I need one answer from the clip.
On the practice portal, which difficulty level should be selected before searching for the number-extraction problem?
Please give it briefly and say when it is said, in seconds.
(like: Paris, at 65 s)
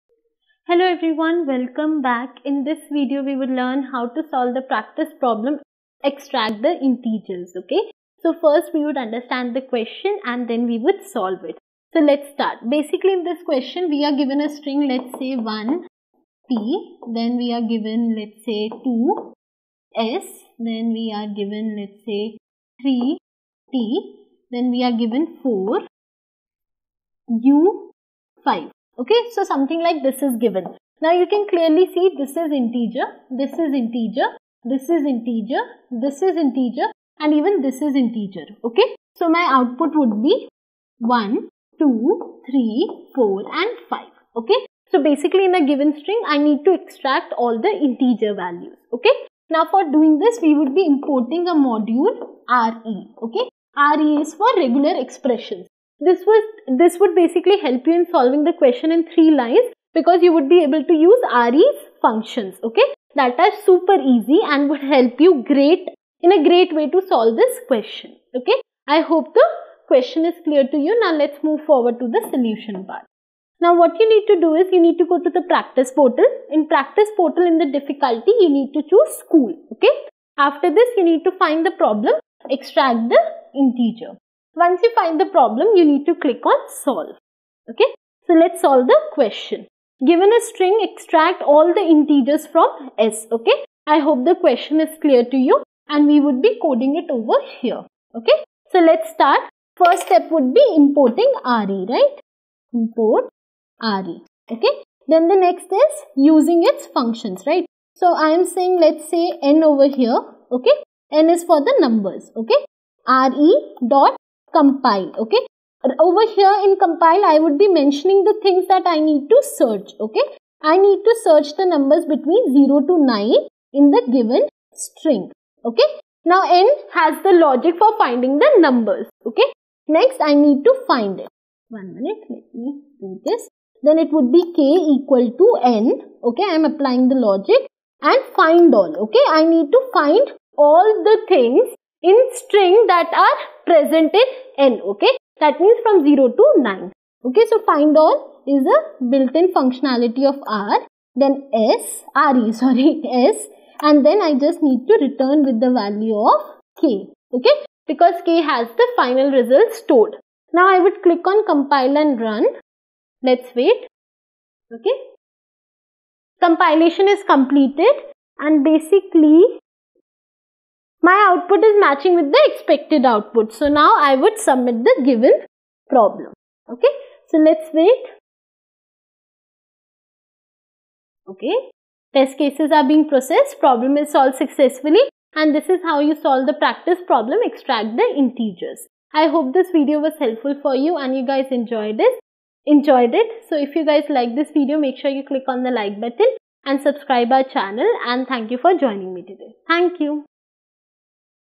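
school, at 79 s.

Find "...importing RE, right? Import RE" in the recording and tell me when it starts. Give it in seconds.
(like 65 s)
100 s.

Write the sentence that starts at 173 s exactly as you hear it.
So now I would submit the given problem.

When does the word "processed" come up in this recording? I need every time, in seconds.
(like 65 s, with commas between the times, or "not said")
183 s.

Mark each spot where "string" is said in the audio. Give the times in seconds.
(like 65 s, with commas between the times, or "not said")
14 s, 46 s, 90 s, 124 s, 142 s.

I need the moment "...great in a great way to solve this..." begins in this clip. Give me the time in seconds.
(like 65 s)
65 s.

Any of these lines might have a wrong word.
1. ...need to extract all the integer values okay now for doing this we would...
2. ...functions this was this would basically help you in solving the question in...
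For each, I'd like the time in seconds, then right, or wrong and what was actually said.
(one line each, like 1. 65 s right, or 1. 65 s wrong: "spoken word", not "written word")
1. 46 s right
2. 55 s wrong: "expressions", not "functions".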